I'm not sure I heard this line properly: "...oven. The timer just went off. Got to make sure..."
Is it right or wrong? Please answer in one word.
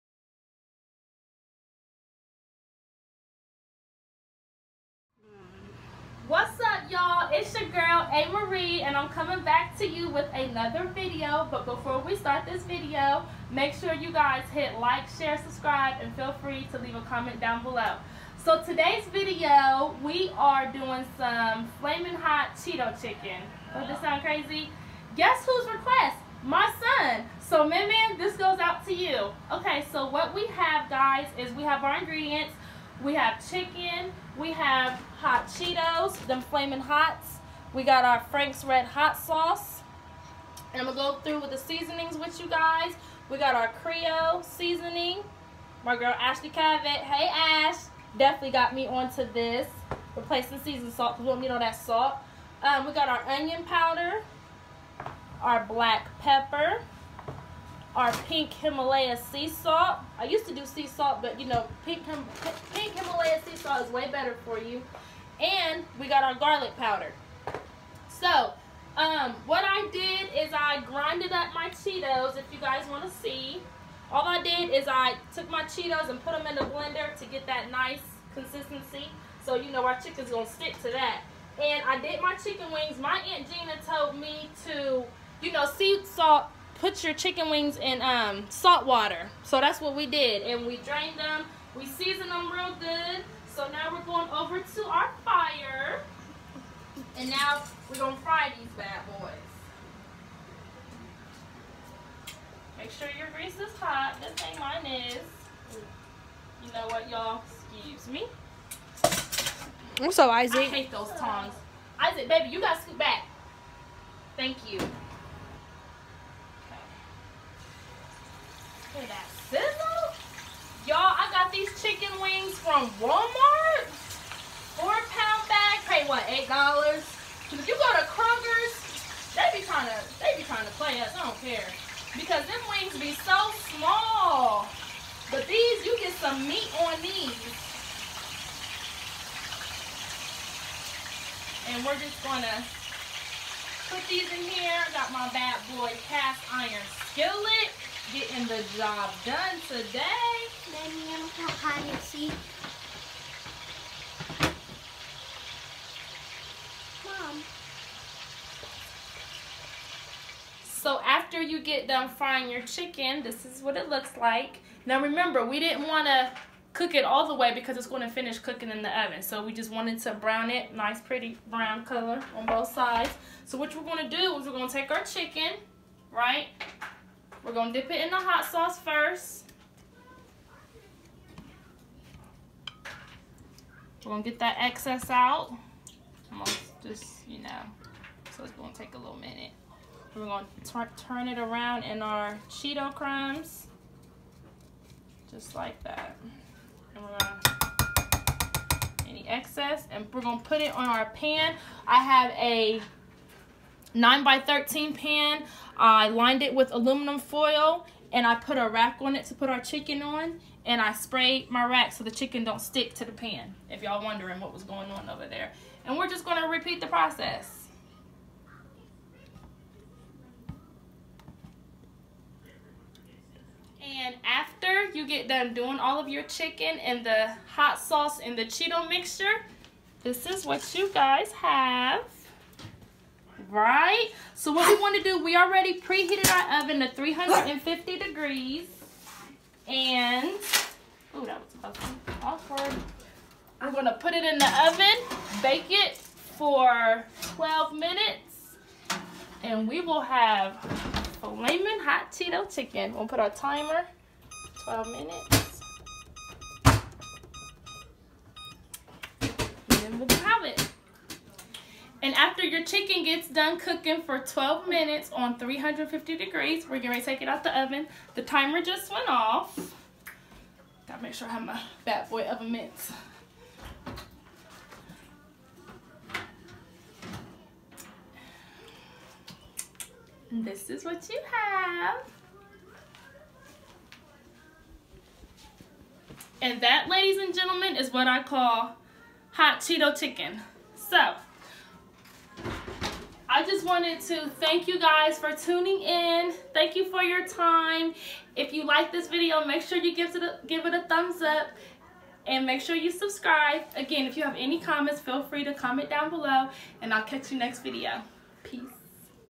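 right.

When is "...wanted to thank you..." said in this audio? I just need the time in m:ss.
4:53.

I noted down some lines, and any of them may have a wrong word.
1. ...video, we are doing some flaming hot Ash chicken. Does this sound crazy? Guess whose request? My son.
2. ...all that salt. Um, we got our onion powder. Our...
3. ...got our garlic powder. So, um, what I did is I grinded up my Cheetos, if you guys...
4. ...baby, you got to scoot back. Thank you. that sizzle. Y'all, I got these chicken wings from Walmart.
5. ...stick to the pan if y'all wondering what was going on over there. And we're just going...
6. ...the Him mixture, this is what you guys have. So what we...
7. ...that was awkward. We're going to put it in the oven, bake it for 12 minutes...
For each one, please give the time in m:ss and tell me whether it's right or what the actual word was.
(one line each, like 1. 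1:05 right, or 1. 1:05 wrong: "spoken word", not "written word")
1. 0:19 wrong: "Cheeto", not "Ash"
2. 0:51 right
3. 1:06 right
4. 1:52 right
5. 3:32 right
6. 3:48 wrong: "Cheeto", not "Him"
7. 4:01 right.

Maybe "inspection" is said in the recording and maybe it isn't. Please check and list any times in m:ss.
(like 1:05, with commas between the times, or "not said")
not said.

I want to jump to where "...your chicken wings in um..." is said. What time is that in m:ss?
1:27.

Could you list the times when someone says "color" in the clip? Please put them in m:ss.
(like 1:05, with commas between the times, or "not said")
2:51.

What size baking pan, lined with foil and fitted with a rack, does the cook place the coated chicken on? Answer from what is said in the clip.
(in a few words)
9 by 13.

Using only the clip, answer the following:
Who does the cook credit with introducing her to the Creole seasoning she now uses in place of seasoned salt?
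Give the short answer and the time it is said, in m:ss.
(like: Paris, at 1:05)
Ashley Cavett, at 0:46.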